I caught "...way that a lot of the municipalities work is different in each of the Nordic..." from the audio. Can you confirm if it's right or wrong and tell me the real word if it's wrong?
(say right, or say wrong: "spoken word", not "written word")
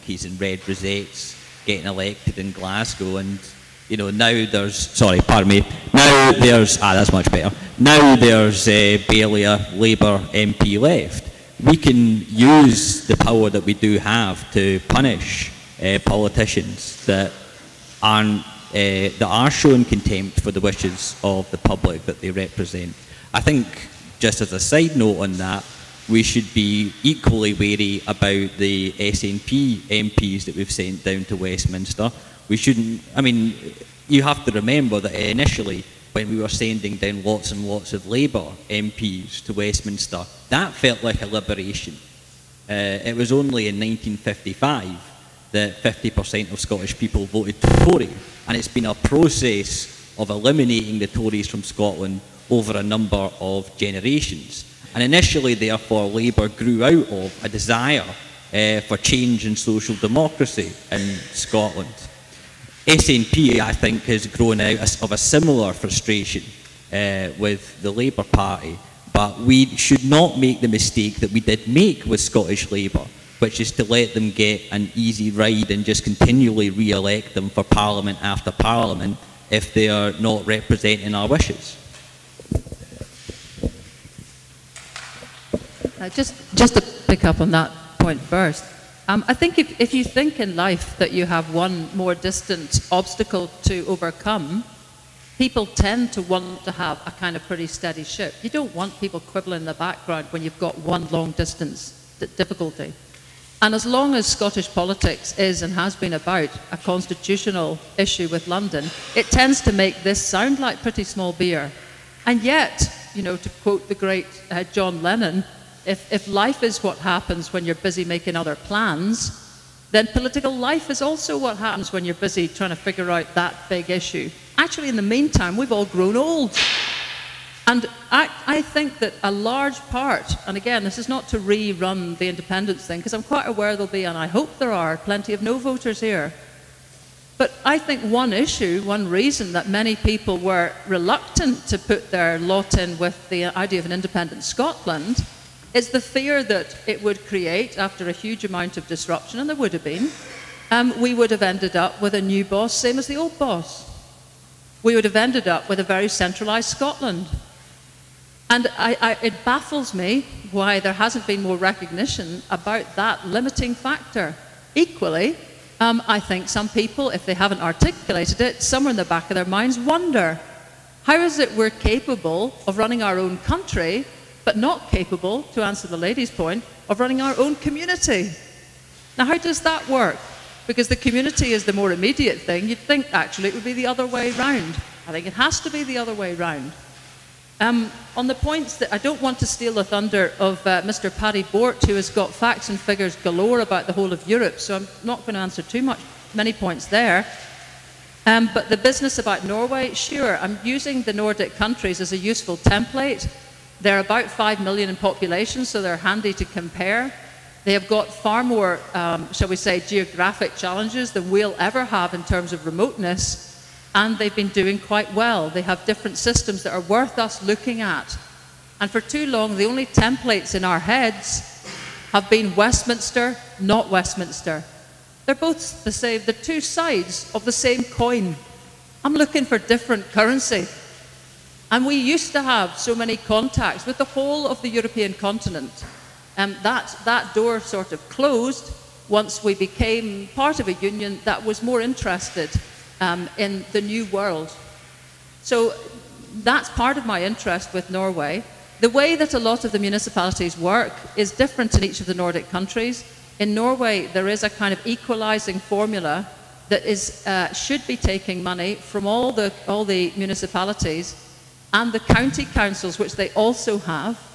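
right.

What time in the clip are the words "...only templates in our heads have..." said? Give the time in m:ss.
3:39.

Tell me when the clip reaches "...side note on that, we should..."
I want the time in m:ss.
0:24.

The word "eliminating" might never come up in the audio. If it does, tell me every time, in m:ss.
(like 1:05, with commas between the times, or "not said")
0:50.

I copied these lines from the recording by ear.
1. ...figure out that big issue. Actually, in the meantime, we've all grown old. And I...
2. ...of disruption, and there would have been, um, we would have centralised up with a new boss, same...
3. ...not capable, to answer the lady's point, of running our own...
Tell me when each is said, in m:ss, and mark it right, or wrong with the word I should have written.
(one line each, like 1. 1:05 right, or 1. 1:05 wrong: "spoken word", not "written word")
1. 2:02 right
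2. 2:28 wrong: "ended", not "centralised"
3. 2:54 right.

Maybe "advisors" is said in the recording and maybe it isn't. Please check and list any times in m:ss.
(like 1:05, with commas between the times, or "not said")
not said.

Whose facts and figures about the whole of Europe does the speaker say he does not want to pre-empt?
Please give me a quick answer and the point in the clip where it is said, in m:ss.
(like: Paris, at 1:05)
Paddy Bort, at 3:11.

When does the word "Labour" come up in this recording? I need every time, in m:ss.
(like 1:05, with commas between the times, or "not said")
0:09, 0:38, 0:56, 1:07, 1:12.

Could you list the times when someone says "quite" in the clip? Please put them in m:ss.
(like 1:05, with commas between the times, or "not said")
2:13, 3:34.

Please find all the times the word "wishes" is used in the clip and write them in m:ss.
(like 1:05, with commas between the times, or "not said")
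0:20, 1:21.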